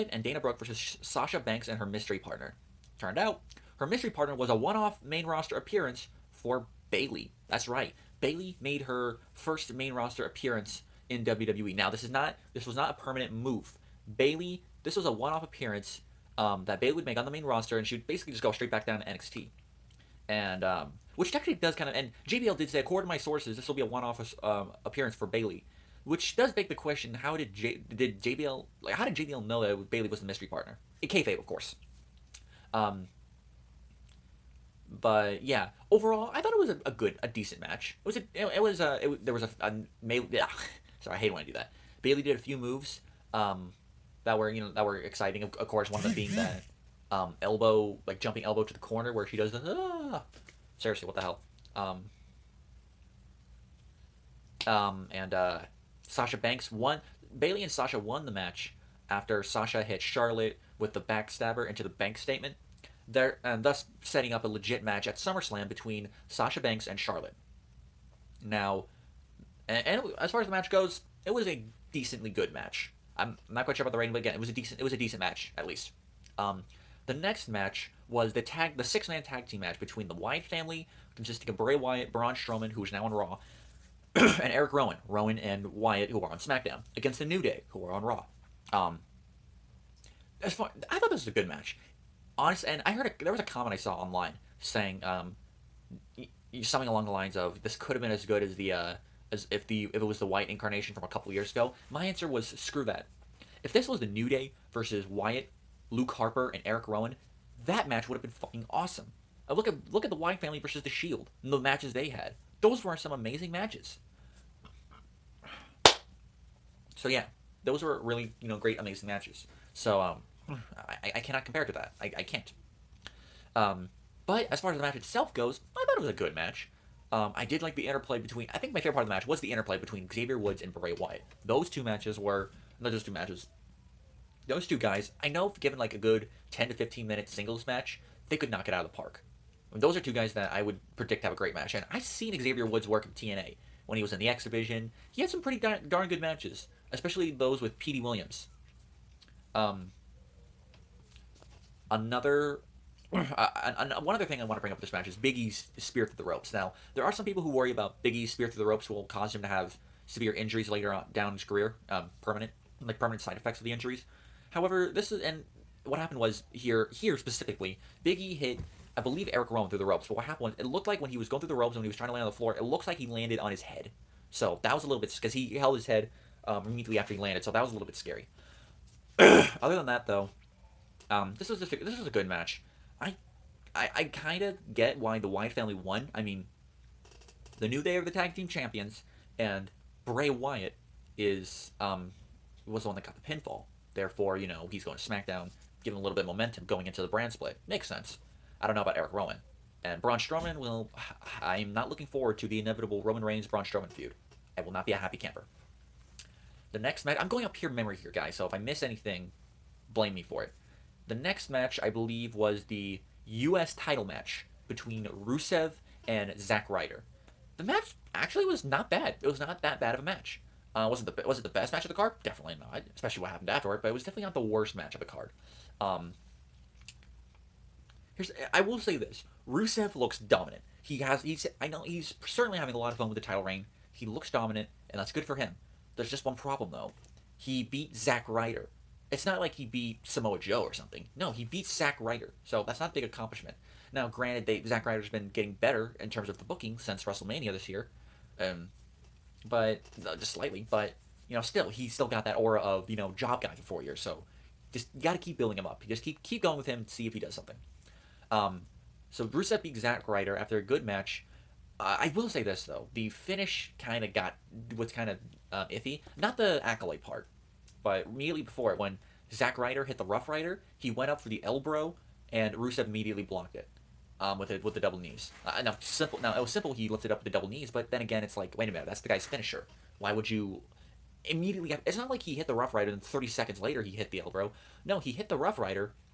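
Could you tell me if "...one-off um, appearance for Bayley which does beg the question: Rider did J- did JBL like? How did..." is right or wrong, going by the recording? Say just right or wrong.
wrong.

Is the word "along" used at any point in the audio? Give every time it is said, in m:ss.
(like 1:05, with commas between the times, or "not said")
1:36.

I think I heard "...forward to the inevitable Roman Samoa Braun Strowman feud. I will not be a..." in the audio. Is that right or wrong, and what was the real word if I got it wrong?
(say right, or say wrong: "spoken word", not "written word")
wrong: "Reigns", not "Samoa".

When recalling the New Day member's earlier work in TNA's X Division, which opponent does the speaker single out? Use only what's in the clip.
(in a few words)
Petey Williams.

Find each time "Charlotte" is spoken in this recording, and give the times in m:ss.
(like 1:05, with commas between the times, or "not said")
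1:00, 1:06.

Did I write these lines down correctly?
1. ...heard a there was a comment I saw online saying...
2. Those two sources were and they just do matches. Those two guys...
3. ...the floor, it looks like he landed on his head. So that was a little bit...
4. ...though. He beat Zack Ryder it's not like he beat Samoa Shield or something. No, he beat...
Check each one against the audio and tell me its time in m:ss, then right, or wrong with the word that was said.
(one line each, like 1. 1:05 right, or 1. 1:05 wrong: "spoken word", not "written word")
1. 1:32 right
2. 2:11 wrong: "matches", not "sources"
3. 2:52 right
4. 3:56 wrong: "Joe", not "Shield".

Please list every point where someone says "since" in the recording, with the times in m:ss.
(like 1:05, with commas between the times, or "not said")
4:06.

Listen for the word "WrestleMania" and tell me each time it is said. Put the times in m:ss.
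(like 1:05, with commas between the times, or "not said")
4:07.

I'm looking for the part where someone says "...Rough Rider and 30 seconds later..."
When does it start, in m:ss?
4:42.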